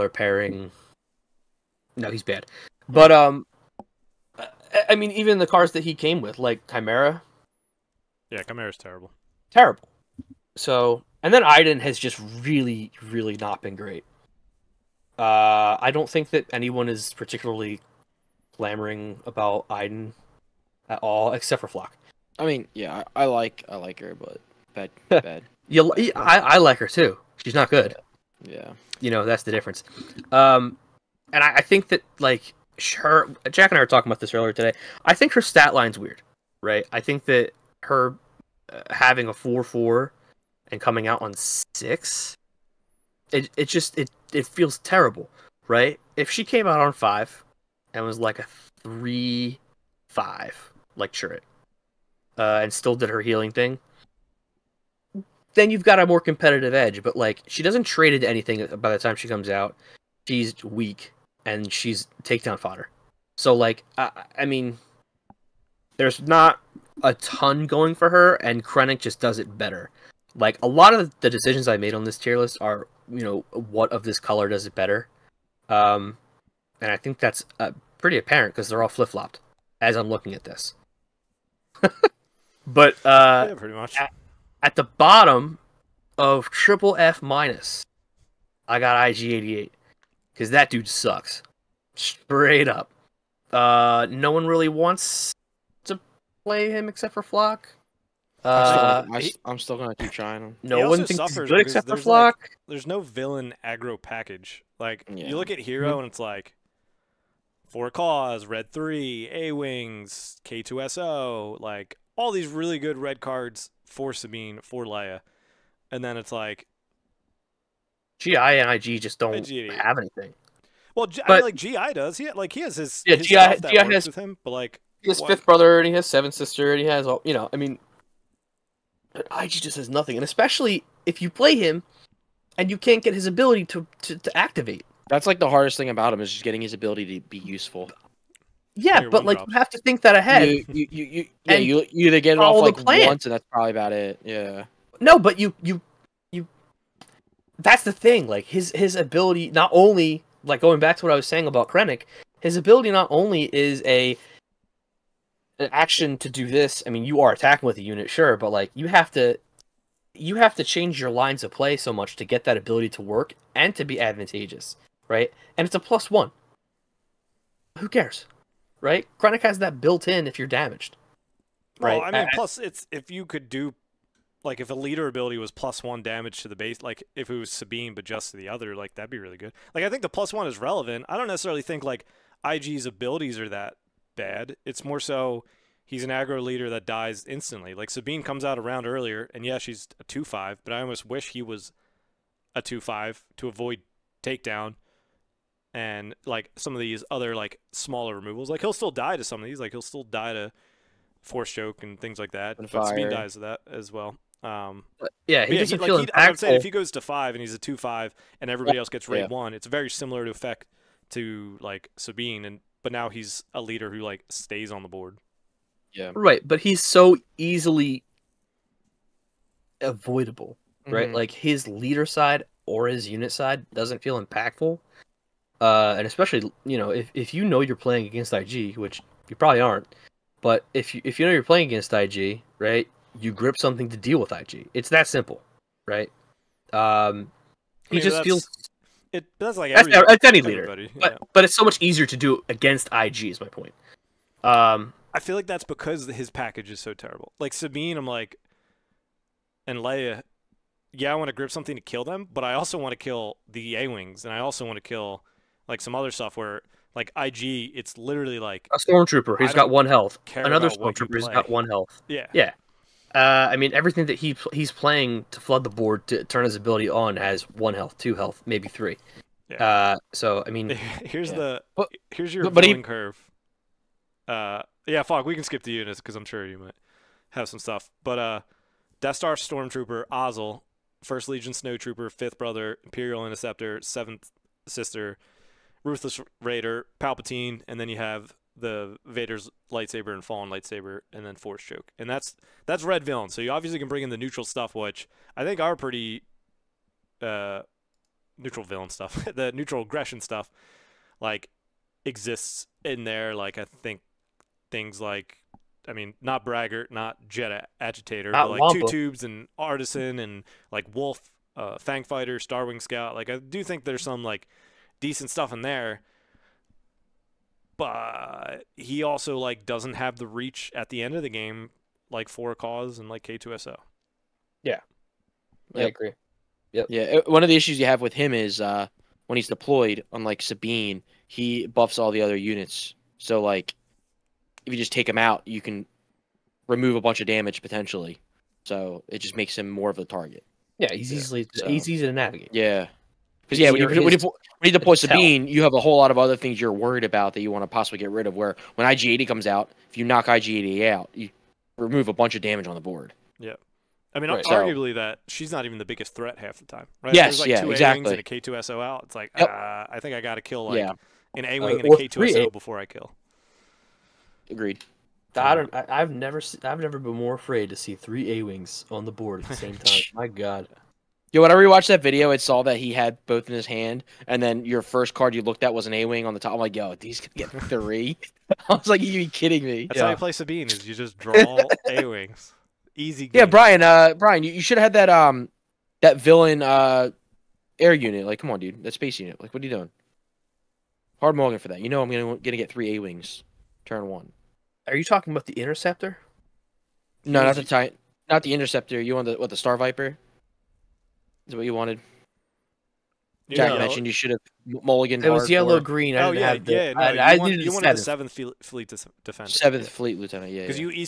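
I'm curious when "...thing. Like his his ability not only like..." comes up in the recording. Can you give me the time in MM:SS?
02:27.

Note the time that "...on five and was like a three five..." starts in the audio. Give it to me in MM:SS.
00:46.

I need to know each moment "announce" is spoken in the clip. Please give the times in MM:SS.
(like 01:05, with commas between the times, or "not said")
not said.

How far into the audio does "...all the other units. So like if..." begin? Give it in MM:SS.
05:31.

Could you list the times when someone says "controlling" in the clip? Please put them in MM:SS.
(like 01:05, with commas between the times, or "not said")
not said.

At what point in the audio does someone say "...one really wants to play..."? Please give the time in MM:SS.
01:34.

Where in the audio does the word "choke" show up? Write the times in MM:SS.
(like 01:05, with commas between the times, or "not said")
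03:21, 04:51.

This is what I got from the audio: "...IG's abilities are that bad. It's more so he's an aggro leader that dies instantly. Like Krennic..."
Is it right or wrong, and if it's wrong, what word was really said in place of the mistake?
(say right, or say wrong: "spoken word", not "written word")
wrong: "Sabine", not "Krennic".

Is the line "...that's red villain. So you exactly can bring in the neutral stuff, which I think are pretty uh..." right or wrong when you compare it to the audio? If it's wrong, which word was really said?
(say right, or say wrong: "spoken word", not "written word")
wrong: "obviously", not "exactly".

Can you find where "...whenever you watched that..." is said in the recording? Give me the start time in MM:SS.
06:11.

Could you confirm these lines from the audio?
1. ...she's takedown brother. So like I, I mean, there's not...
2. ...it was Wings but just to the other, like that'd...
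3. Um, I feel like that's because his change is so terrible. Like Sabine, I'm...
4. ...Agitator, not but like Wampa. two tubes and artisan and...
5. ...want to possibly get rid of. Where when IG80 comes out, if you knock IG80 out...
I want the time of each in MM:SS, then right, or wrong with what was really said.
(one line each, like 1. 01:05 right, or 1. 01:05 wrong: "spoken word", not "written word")
1. 01:01 wrong: "fodder", not "brother"
2. 02:57 wrong: "Sabine", not "Wings"
3. 04:04 wrong: "package", not "change"
4. 05:07 right
5. 05:47 right.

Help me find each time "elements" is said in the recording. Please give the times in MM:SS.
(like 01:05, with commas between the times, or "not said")
not said.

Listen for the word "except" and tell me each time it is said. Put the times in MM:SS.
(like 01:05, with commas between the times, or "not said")
00:21, 01:36, 01:41.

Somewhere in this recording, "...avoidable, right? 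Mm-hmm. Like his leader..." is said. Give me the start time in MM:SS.
03:39.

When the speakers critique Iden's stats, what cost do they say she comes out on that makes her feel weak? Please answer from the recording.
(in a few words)
6.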